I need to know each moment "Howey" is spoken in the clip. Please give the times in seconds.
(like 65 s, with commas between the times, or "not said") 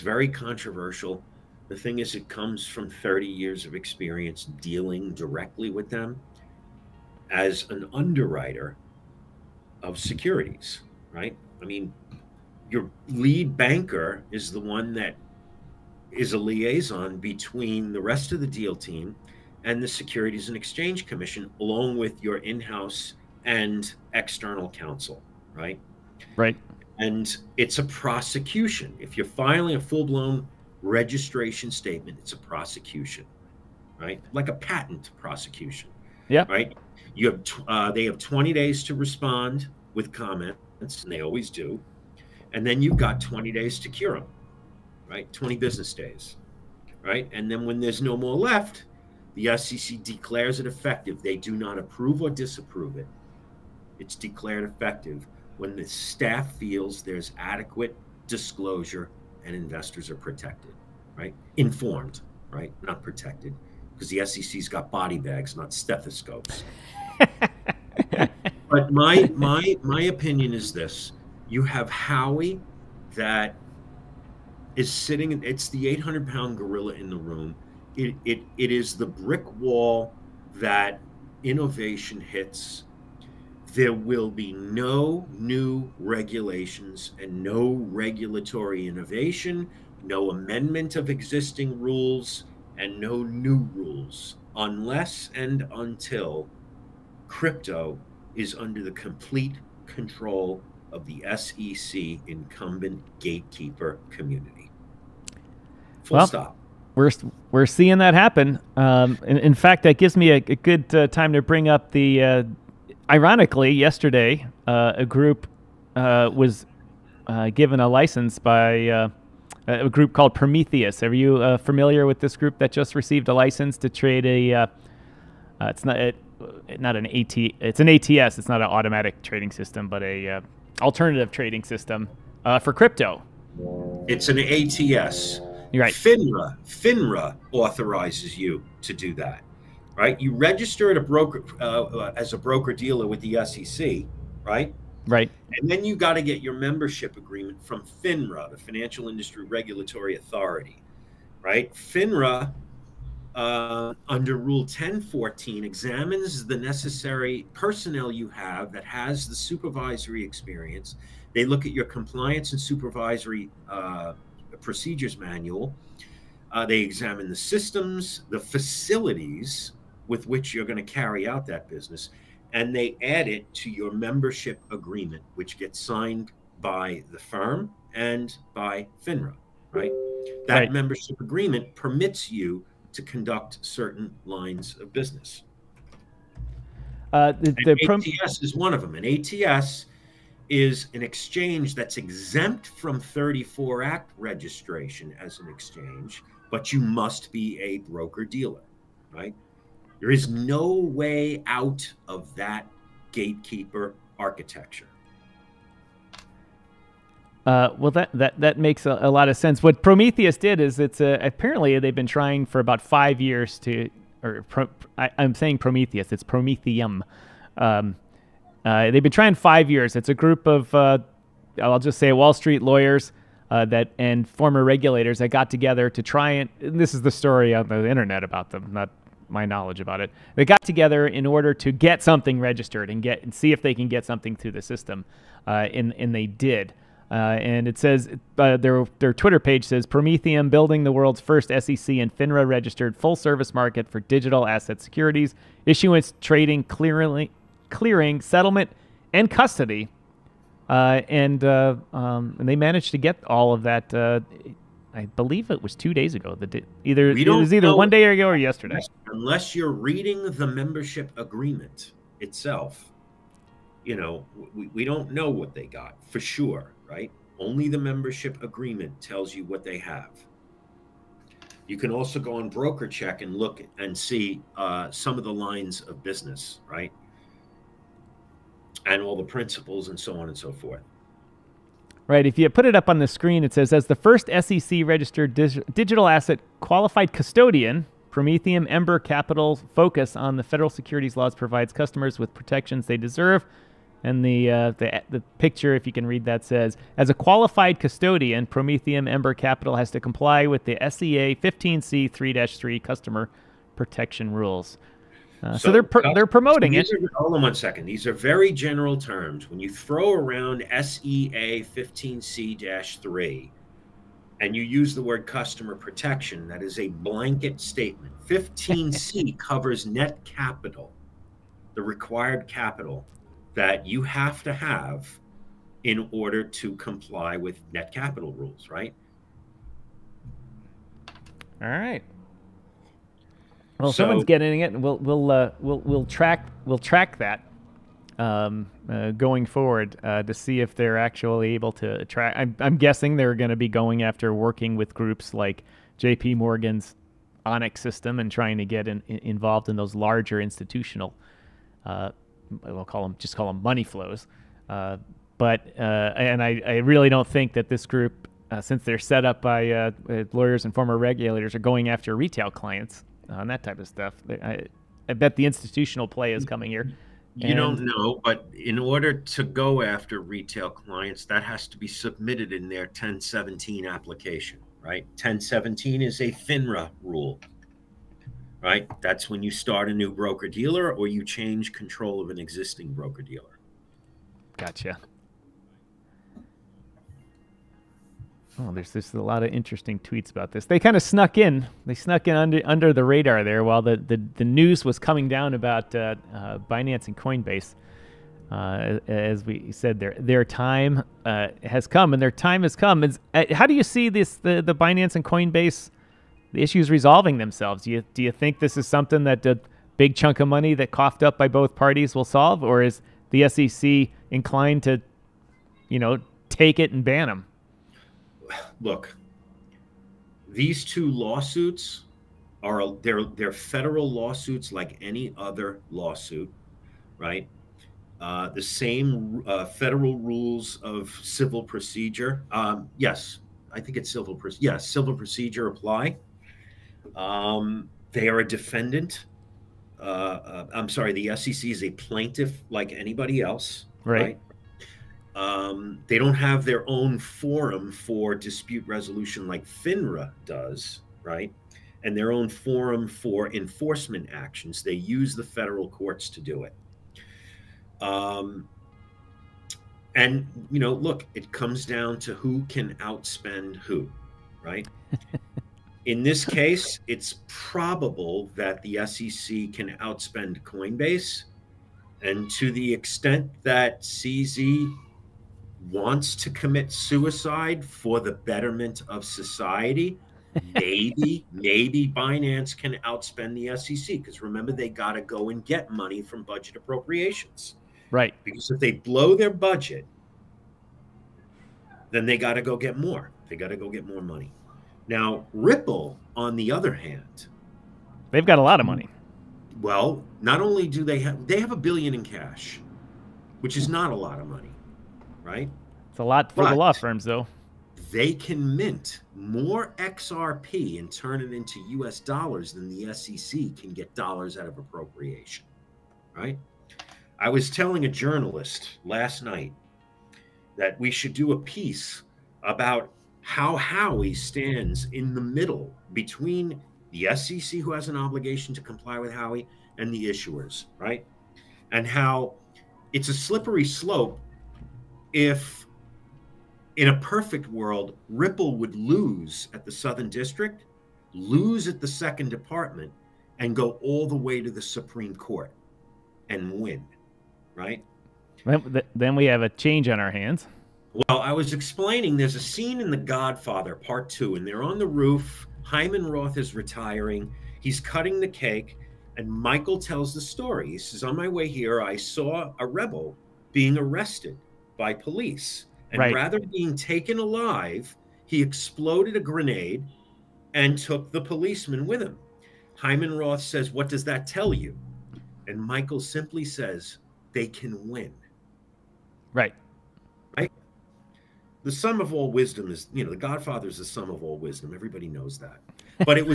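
71 s, 523 s, 529 s.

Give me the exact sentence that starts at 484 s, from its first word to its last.
Because remember, they got to go and get money from budget appropriations.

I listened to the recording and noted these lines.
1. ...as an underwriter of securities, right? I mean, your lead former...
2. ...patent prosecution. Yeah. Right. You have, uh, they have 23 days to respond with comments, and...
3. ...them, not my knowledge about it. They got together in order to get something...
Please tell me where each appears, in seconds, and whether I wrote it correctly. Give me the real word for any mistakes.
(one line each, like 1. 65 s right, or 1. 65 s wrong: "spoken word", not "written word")
1. 7 s wrong: "banker", not "former"
2. 34 s wrong: "20", not "23"
3. 228 s right.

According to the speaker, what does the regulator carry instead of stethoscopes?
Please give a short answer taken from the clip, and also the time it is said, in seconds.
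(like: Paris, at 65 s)
body bags, at 64 s.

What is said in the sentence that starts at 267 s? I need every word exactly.
Only the membership agreement tells you what they have.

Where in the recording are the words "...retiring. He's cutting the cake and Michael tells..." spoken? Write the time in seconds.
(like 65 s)
556 s.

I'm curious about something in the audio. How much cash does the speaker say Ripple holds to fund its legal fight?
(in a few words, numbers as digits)
a billion.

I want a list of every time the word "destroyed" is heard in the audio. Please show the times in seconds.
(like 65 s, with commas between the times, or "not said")
not said.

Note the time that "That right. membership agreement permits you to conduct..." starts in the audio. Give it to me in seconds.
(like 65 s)
180 s.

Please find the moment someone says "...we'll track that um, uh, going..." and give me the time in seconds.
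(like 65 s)
336 s.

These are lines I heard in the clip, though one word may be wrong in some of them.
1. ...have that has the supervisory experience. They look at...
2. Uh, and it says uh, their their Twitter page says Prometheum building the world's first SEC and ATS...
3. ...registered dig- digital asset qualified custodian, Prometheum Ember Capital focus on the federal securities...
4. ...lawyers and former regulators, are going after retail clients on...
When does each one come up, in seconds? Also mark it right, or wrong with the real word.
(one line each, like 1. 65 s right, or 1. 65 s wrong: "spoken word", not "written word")
1. 158 s right
2. 237 s wrong: "FINRA", not "ATS"
3. 284 s right
4. 360 s right.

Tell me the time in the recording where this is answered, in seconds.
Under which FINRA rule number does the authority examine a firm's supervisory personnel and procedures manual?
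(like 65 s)
154 s.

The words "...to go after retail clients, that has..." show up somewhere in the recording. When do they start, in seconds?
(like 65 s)
369 s.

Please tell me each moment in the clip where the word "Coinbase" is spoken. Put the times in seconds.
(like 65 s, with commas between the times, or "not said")
397 s, 405 s, 470 s.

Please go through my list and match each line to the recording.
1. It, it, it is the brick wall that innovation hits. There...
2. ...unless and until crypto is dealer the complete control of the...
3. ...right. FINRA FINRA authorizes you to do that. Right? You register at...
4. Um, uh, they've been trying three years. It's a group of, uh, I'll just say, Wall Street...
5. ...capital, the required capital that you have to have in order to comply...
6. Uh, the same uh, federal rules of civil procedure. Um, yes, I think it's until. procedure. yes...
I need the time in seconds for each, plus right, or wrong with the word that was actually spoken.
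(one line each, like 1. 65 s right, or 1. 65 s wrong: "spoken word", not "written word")
1. 77 s right
2. 94 s wrong: "under", not "dealer"
3. 135 s right
4. 217 s wrong: "five", not "three"
5. 320 s right
6. 428 s wrong: "civil", not "until".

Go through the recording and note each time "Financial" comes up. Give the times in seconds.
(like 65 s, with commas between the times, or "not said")
148 s.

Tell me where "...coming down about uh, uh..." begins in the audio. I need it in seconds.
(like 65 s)
394 s.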